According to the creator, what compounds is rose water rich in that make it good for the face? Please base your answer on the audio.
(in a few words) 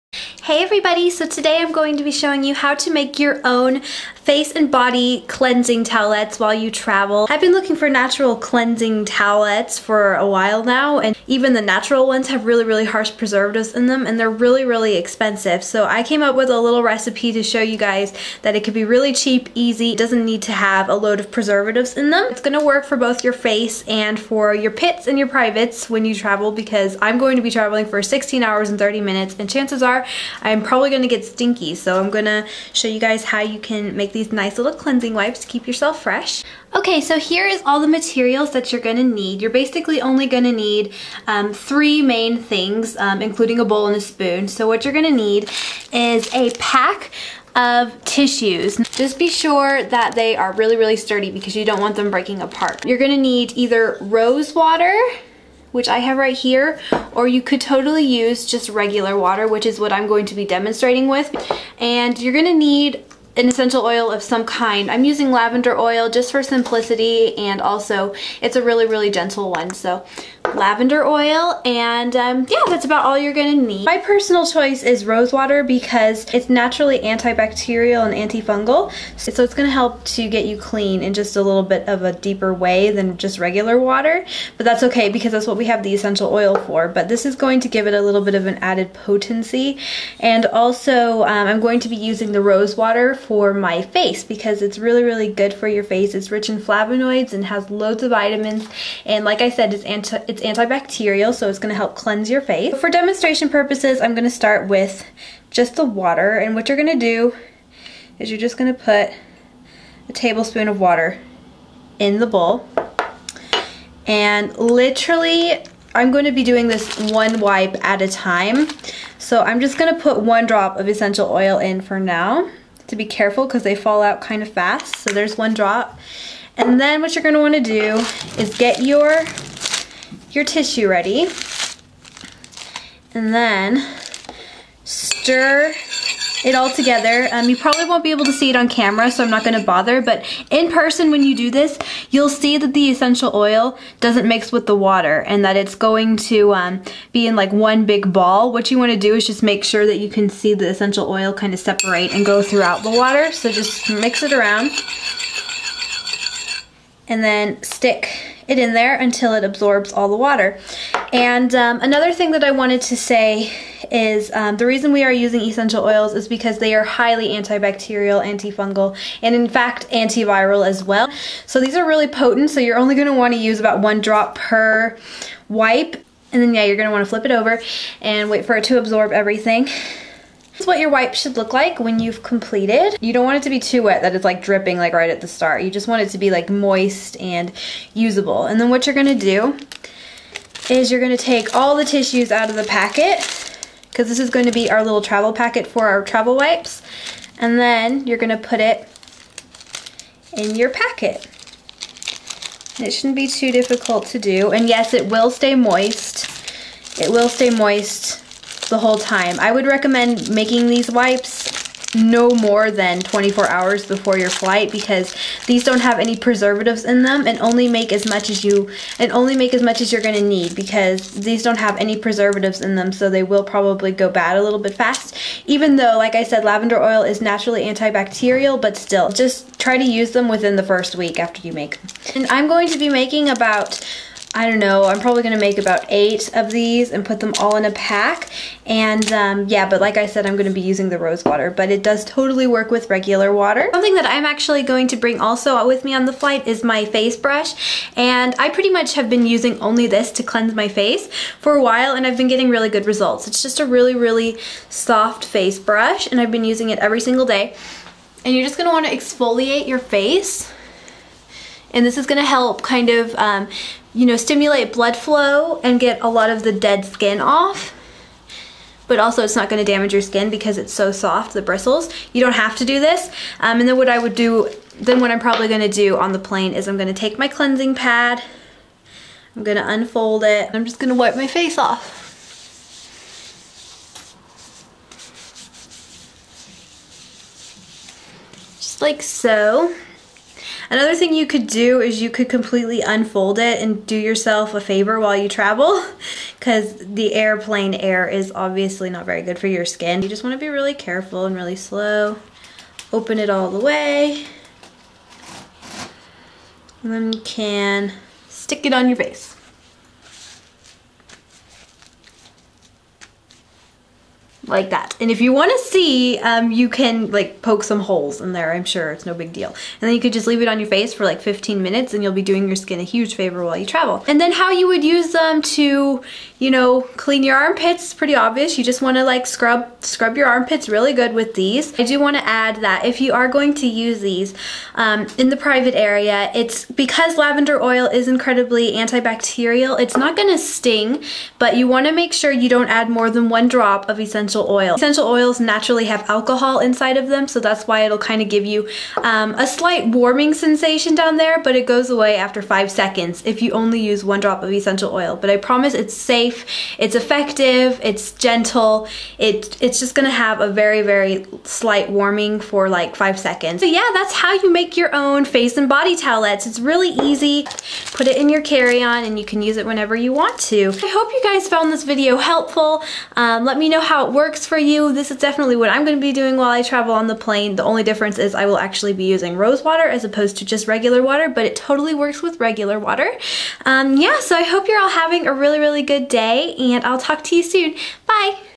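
Flavonoids.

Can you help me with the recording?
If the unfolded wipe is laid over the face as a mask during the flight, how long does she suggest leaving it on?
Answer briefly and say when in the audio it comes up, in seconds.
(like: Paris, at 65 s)
15 minutes, at 321 s.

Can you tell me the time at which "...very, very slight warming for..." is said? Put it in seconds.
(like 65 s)
360 s.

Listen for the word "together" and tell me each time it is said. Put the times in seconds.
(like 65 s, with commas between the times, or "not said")
136 s.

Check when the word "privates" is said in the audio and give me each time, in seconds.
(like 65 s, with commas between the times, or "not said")
25 s, 335 s.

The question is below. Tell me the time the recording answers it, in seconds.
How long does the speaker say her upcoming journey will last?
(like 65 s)
28 s.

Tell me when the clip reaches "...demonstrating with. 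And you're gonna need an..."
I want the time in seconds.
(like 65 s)
60 s.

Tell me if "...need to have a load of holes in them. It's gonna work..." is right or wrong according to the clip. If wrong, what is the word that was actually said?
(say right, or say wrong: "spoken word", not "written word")
wrong: "preservatives", not "holes".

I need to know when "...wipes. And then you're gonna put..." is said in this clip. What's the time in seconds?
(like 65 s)
196 s.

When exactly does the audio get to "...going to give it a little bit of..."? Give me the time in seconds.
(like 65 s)
87 s.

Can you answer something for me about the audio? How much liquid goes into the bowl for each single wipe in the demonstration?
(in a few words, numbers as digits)
1 tablespoon.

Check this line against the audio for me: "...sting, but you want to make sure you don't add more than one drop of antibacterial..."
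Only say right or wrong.
wrong.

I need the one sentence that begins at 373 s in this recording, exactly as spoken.
Um, let me know how it works works for you.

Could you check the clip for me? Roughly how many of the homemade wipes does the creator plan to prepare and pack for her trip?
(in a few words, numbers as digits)
8.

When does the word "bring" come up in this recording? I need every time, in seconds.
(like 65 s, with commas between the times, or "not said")
244 s.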